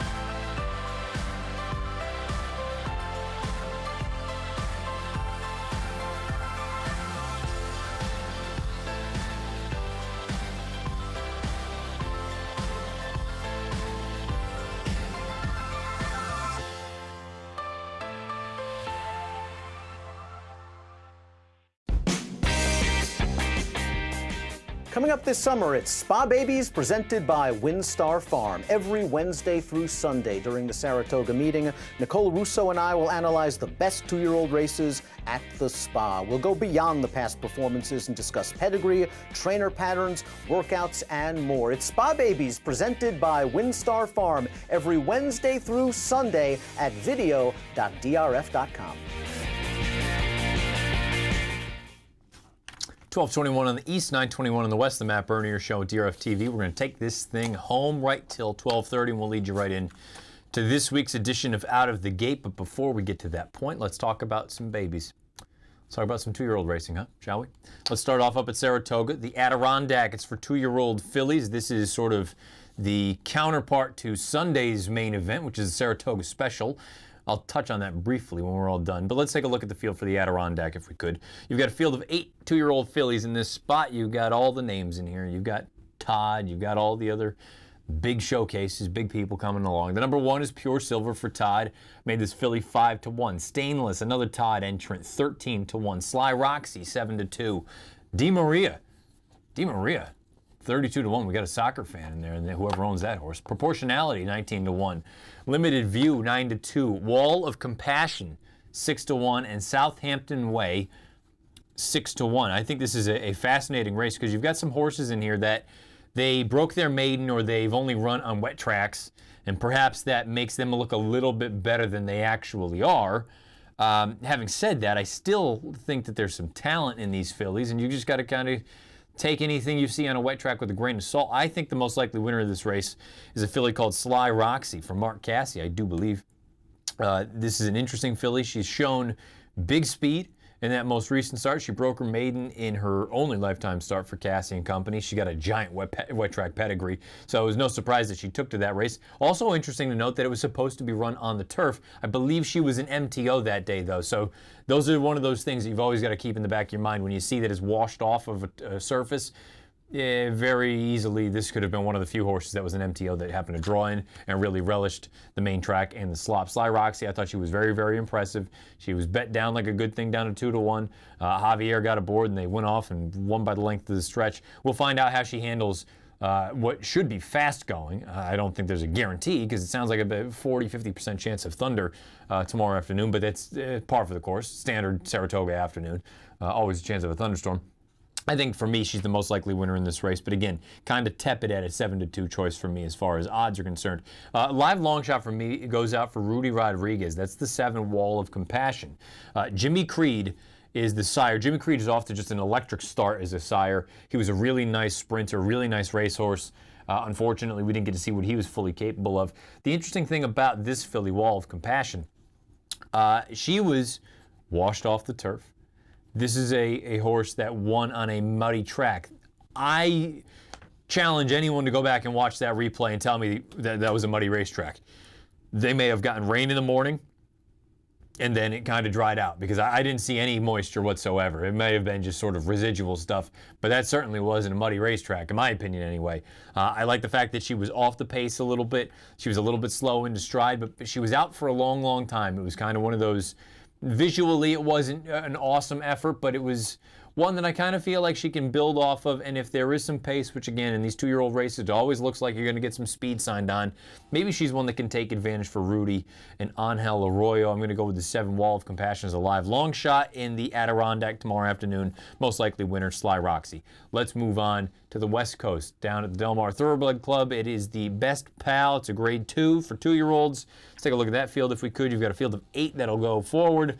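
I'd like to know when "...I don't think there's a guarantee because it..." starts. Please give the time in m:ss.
2:58.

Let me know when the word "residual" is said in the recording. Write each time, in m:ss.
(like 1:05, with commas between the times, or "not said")
3:52.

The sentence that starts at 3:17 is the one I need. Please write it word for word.
That's the seven wall of compassion.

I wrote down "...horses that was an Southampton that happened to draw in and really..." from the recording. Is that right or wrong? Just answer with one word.
wrong.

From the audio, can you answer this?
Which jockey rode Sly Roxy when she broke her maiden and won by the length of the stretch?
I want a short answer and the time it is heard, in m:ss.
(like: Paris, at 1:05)
Javier, at 2:51.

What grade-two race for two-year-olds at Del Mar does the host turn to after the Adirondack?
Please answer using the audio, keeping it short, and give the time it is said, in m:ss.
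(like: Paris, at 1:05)
Best Pal, at 4:27.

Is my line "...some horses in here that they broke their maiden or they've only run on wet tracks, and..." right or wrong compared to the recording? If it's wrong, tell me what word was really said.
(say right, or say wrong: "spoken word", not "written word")
right.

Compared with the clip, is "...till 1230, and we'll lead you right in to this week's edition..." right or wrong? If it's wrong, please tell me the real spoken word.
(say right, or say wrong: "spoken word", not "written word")
right.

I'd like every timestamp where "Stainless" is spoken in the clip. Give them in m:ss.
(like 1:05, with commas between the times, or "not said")
1:33.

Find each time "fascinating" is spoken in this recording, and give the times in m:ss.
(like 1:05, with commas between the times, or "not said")
1:53.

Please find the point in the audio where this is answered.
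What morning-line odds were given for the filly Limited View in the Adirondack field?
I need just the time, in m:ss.
1:45.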